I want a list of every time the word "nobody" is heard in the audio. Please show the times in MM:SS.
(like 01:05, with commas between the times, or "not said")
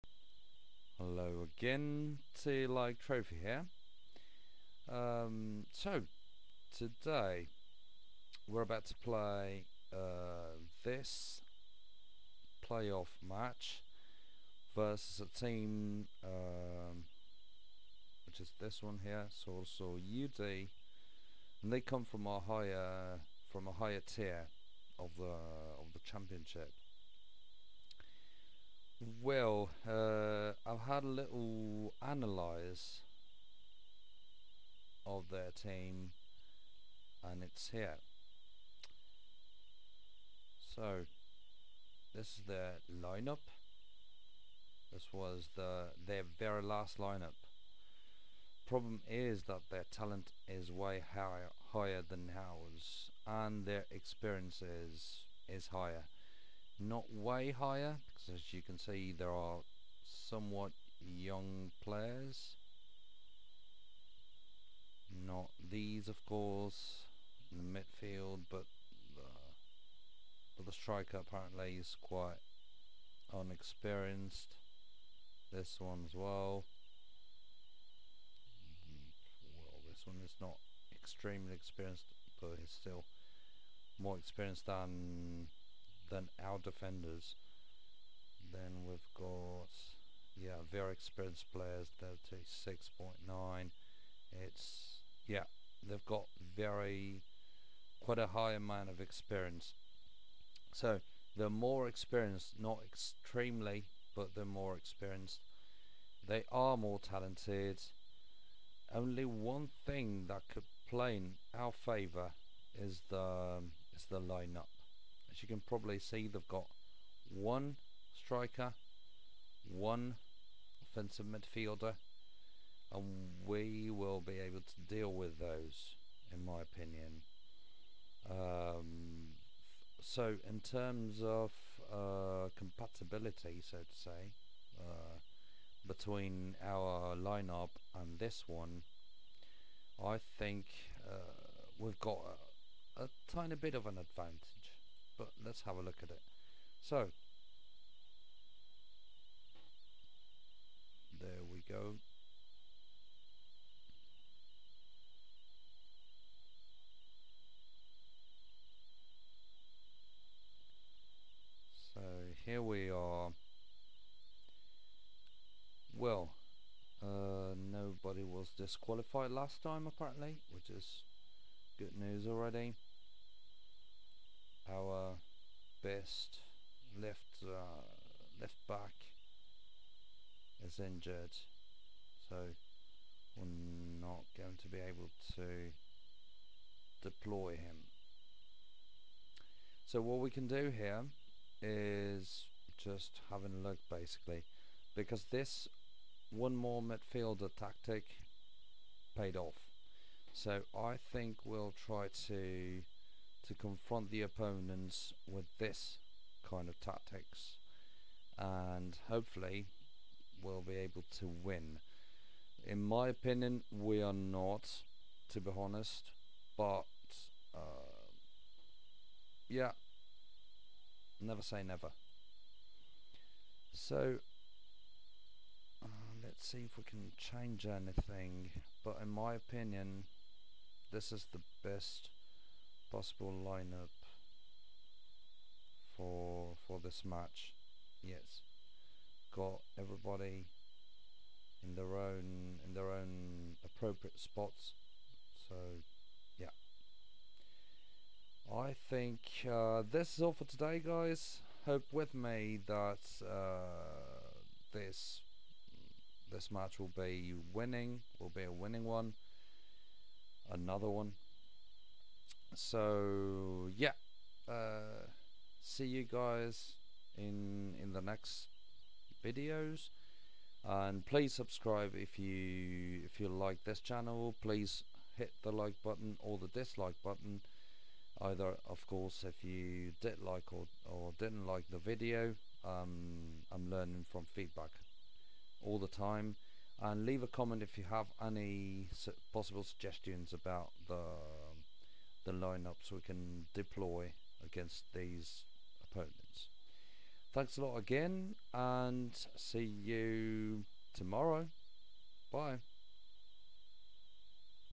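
02:47.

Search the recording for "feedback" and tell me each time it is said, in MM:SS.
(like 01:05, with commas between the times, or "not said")
04:44.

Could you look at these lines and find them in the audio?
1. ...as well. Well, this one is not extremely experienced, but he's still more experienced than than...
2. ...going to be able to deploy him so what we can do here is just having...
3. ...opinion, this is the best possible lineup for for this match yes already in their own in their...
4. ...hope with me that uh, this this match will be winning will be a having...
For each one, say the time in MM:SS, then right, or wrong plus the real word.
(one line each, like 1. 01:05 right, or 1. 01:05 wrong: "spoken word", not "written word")
1. 01:16 right
2. 03:04 right
3. 03:49 wrong: "everybody", not "already"
4. 04:11 wrong: "winning", not "having".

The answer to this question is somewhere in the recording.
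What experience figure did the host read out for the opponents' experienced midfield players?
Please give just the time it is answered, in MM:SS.
01:32.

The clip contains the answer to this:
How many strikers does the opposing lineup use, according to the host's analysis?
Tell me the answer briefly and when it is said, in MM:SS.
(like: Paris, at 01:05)
1, at 01:57.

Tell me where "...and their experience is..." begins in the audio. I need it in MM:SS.
00:53.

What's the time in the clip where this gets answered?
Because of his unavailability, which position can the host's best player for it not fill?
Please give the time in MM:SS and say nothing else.
02:58.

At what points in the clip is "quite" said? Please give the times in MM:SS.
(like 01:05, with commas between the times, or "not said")
01:12, 01:37.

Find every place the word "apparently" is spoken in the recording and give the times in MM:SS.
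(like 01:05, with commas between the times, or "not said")
01:11, 02:49.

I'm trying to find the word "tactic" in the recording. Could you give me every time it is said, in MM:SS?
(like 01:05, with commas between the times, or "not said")
03:17, 03:26.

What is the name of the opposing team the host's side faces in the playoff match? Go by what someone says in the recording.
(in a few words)
UD.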